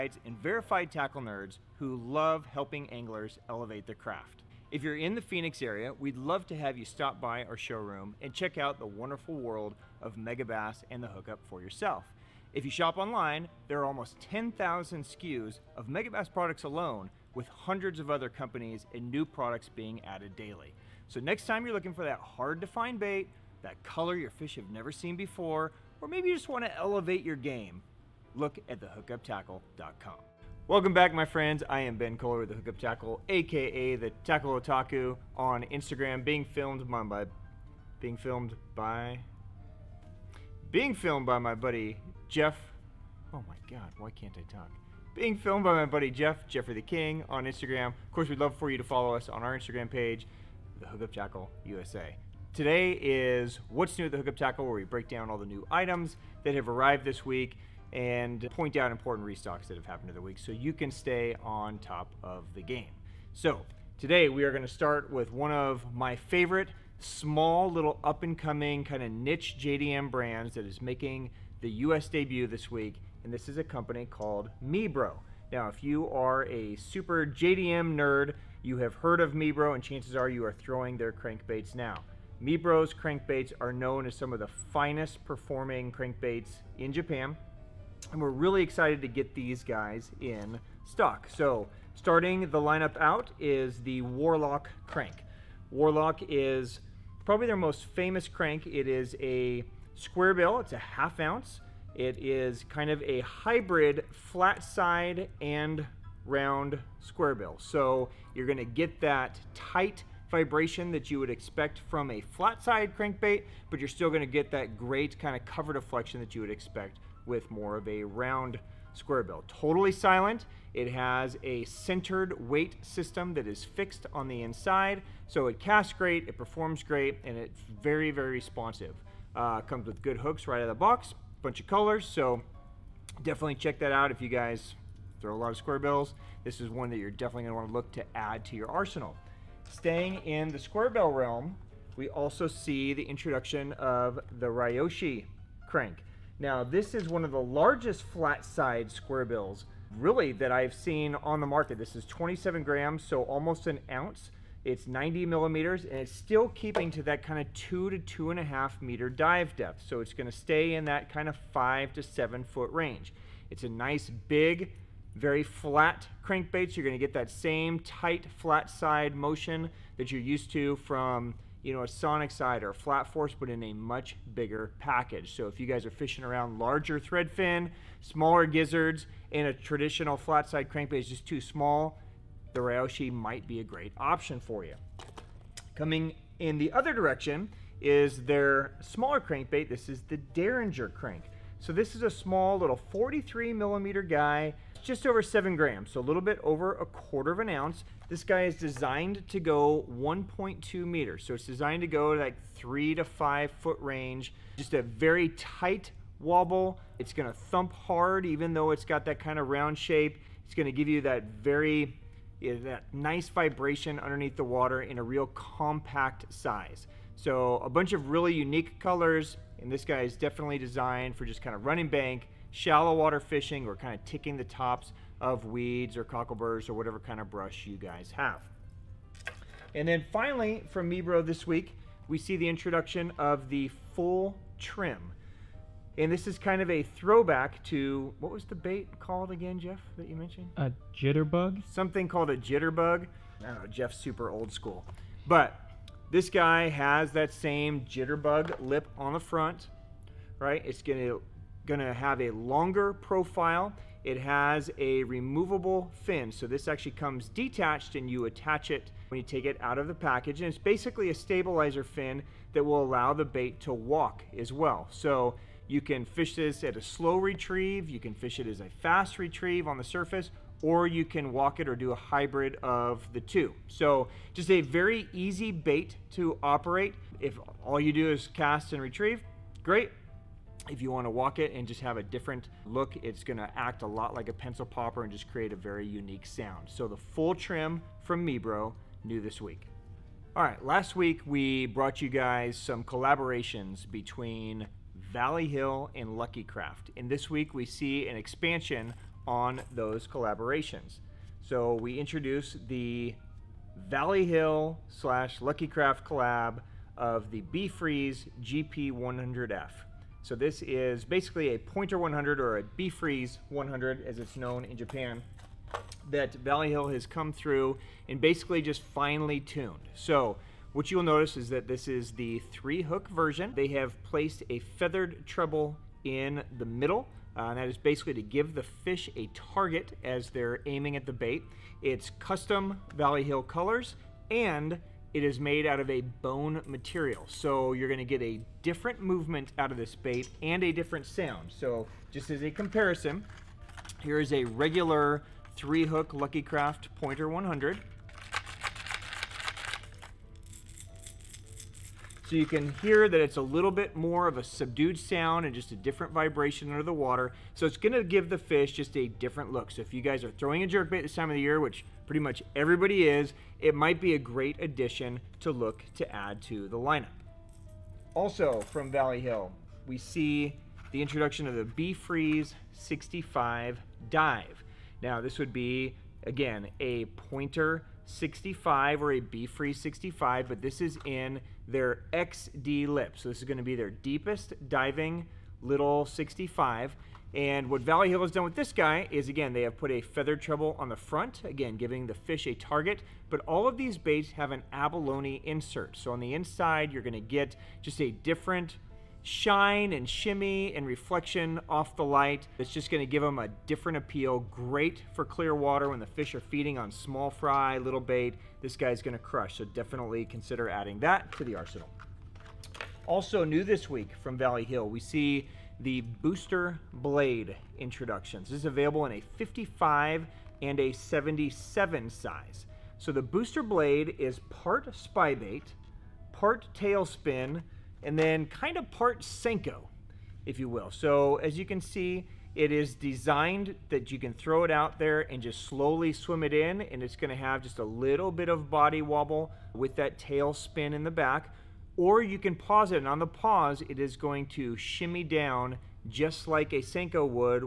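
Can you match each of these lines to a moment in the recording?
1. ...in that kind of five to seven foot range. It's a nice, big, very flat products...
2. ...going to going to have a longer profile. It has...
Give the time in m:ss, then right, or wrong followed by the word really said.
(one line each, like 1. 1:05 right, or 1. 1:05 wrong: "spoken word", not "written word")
1. 2:40 wrong: "crankbaits", not "products"
2. 4:10 right.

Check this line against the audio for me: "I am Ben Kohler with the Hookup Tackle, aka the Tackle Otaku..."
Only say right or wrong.
right.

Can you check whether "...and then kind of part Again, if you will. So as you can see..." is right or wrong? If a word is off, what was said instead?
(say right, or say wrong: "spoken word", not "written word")
wrong: "Senko", not "Again".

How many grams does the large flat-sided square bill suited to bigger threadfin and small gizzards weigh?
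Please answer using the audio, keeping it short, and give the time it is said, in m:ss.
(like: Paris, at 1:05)
27, at 2:32.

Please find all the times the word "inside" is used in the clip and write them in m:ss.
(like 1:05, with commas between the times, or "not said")
2:04, 6:36.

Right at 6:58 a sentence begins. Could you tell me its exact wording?
This is available in a 55 and a 77 size.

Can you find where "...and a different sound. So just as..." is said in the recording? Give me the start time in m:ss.
5:40.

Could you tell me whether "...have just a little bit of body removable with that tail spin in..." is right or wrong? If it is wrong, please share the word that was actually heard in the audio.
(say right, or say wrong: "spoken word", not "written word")
wrong: "wobble", not "removable".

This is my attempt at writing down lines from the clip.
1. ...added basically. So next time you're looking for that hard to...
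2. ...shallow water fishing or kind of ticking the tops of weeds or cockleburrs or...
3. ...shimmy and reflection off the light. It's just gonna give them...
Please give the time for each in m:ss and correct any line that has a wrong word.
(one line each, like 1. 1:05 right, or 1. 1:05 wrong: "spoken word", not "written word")
1. 0:20 wrong: "daily", not "basically"
2. 3:42 right
3. 6:40 right.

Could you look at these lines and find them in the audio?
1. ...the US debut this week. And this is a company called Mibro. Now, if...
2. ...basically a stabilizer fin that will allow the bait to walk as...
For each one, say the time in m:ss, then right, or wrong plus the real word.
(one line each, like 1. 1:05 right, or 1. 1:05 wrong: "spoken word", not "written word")
1. 1:11 right
2. 4:20 right.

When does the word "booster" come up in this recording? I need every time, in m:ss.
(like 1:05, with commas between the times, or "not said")
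6:56, 7:03.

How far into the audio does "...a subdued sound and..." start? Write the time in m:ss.
5:54.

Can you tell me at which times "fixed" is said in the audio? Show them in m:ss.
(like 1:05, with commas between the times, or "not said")
2:03.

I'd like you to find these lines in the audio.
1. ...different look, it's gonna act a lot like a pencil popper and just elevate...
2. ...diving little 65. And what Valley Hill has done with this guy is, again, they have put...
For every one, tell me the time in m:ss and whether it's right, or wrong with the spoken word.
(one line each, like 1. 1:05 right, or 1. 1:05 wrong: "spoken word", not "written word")
1. 4:42 wrong: "create", not "elevate"
2. 6:24 right.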